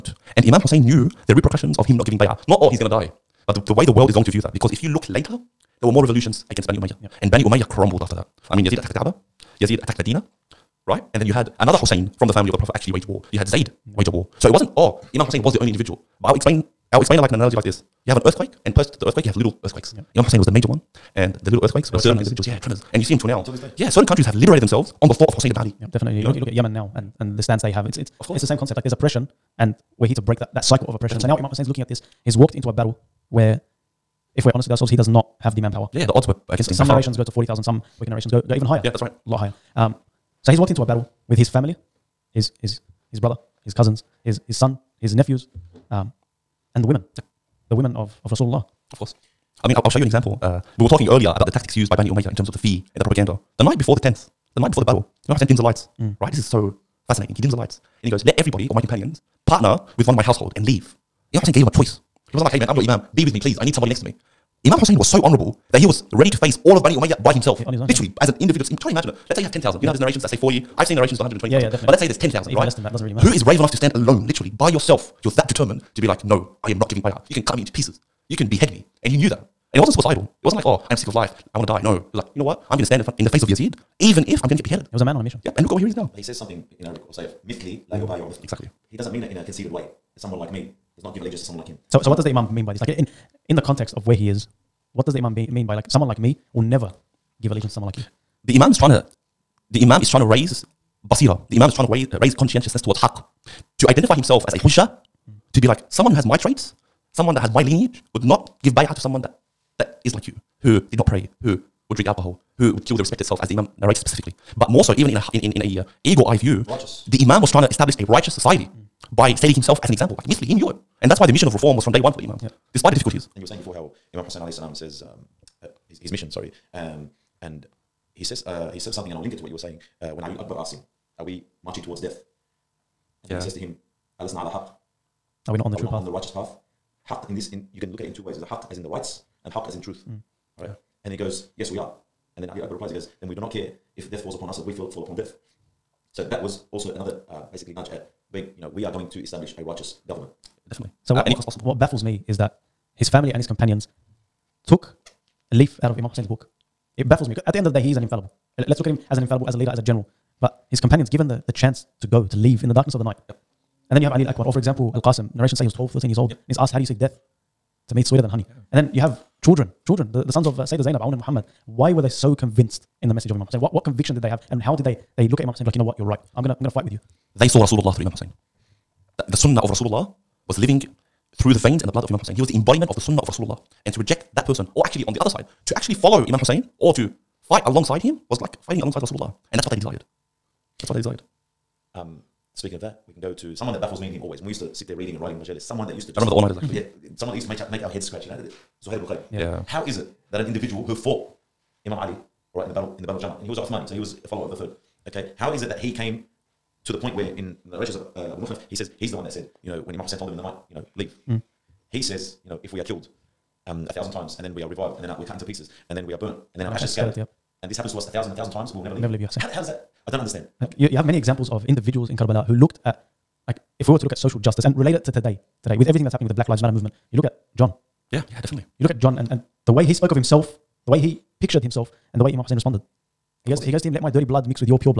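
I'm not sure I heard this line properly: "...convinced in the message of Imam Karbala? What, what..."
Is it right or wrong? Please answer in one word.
wrong.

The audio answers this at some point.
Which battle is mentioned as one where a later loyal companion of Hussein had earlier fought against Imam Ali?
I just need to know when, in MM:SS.
03:23.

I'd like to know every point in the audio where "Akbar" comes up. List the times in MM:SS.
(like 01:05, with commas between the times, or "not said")
02:10, 02:22, 02:44.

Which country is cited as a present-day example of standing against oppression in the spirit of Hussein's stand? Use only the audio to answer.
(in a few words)
Yemen.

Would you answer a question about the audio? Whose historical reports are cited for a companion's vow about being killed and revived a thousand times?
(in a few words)
Abu Mikhnaf.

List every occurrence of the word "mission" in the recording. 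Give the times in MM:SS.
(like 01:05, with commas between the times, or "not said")
01:25, 02:01, 02:06.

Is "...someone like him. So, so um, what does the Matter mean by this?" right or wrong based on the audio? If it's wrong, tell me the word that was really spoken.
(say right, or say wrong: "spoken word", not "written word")
wrong: "Imam", not "Matter".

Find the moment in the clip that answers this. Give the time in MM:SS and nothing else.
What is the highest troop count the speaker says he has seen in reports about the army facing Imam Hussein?
01:11.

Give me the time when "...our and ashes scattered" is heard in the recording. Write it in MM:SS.
03:36.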